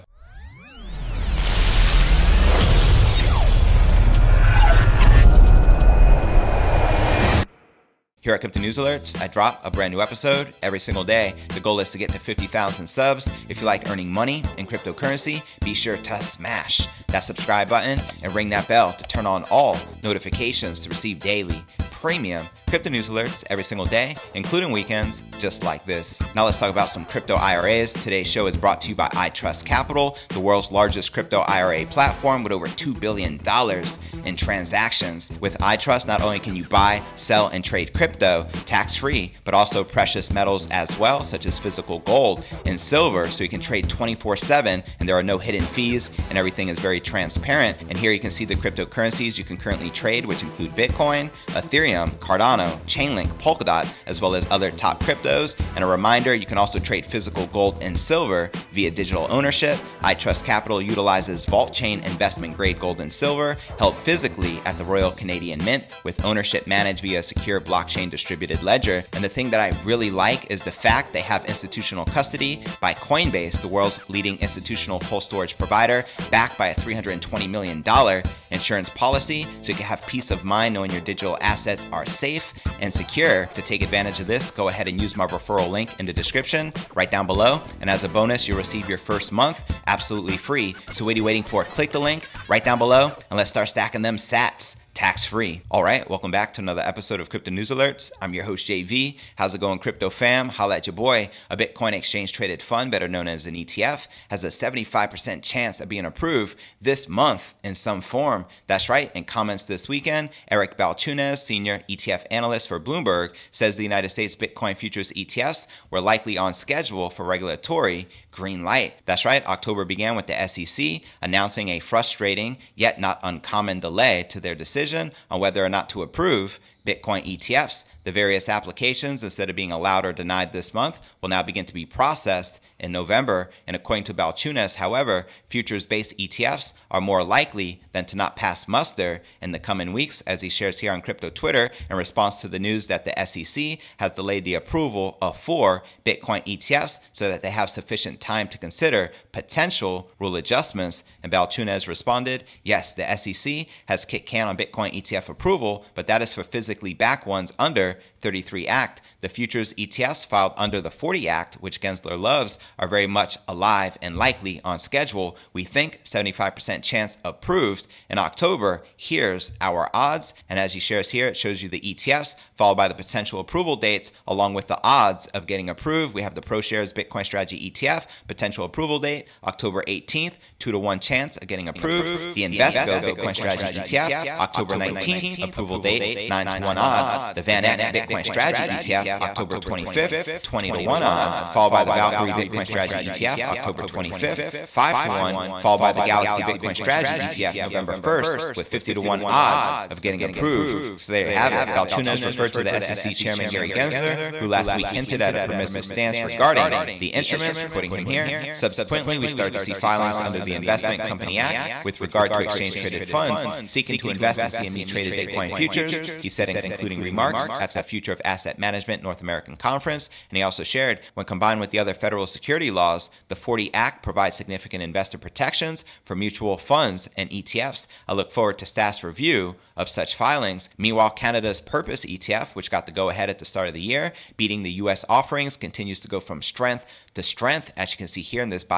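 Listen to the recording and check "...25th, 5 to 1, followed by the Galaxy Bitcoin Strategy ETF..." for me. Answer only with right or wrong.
right.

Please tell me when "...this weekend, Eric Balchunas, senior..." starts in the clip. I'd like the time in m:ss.
1:49.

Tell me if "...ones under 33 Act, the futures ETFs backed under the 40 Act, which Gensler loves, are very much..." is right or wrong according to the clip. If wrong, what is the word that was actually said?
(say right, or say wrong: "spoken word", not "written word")
wrong: "filed", not "backed".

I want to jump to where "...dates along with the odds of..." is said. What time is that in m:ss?
2:53.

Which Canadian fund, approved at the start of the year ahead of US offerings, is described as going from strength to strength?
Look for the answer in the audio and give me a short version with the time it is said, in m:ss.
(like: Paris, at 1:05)
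Purpose ETF, at 3:51.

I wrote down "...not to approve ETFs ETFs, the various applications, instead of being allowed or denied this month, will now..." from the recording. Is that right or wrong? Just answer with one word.
wrong.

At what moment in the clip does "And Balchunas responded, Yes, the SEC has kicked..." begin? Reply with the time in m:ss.
2:31.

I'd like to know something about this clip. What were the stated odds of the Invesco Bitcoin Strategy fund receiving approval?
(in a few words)
9 to 1.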